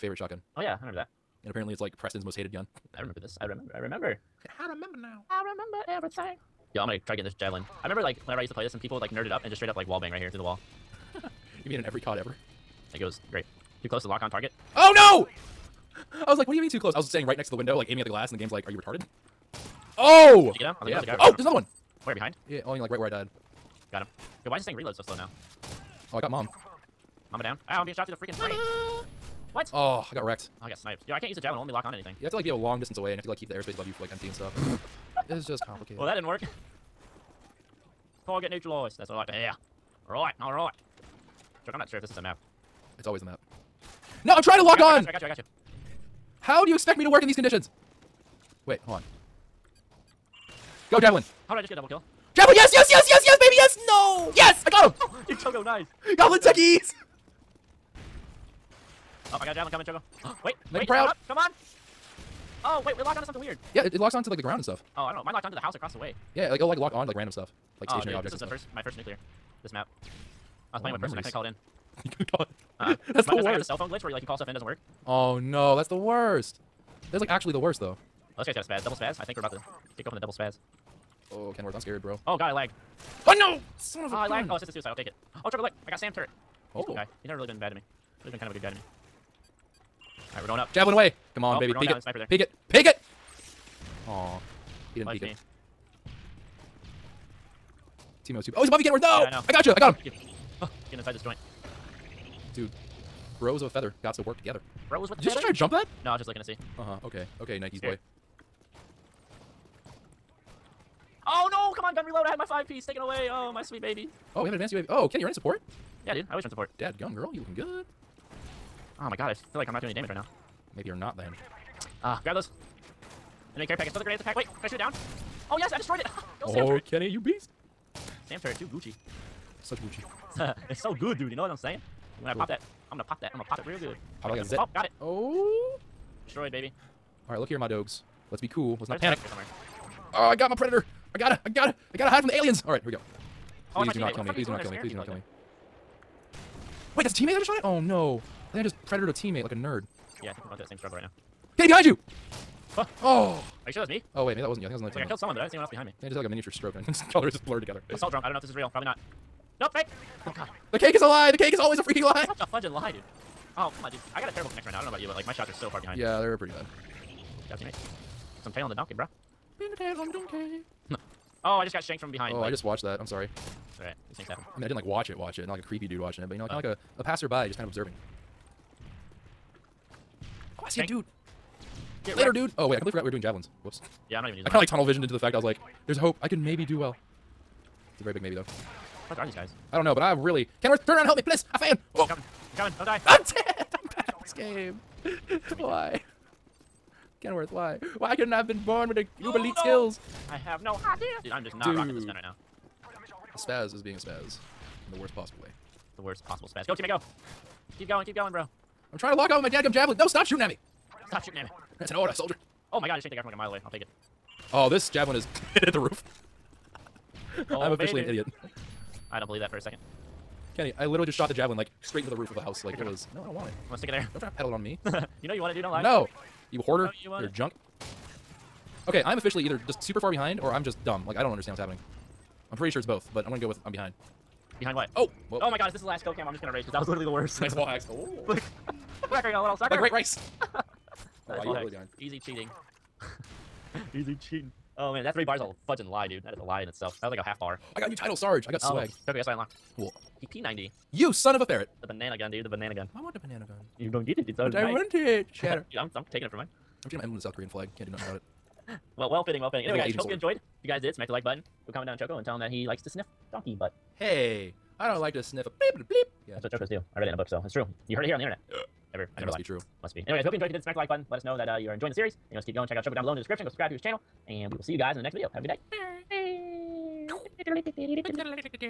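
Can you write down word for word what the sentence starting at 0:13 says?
Too close to lock on target.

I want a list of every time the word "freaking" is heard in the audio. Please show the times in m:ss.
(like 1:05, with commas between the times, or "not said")
0:28, 2:41.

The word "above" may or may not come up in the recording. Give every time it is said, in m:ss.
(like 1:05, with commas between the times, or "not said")
0:33, 1:38.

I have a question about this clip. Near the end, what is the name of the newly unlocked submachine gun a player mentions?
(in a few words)
PP90.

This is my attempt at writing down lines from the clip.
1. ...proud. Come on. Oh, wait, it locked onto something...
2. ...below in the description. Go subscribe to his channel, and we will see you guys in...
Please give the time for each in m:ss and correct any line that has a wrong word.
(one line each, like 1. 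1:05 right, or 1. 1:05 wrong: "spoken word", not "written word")
1. 1:00 right
2. 4:33 right.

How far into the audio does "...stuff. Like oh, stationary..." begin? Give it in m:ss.
1:07.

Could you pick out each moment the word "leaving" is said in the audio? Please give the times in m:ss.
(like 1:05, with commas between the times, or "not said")
not said.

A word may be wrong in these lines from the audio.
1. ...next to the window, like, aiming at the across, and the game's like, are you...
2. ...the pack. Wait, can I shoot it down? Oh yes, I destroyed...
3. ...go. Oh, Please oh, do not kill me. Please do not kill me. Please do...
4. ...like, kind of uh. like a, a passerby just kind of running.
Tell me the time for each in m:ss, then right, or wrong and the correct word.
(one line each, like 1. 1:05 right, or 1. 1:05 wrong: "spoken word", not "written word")
1. 0:17 wrong: "glass", not "across"
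2. 2:04 right
3. 2:22 right
4. 2:56 wrong: "observing", not "running".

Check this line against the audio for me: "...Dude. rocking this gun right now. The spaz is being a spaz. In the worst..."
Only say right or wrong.
right.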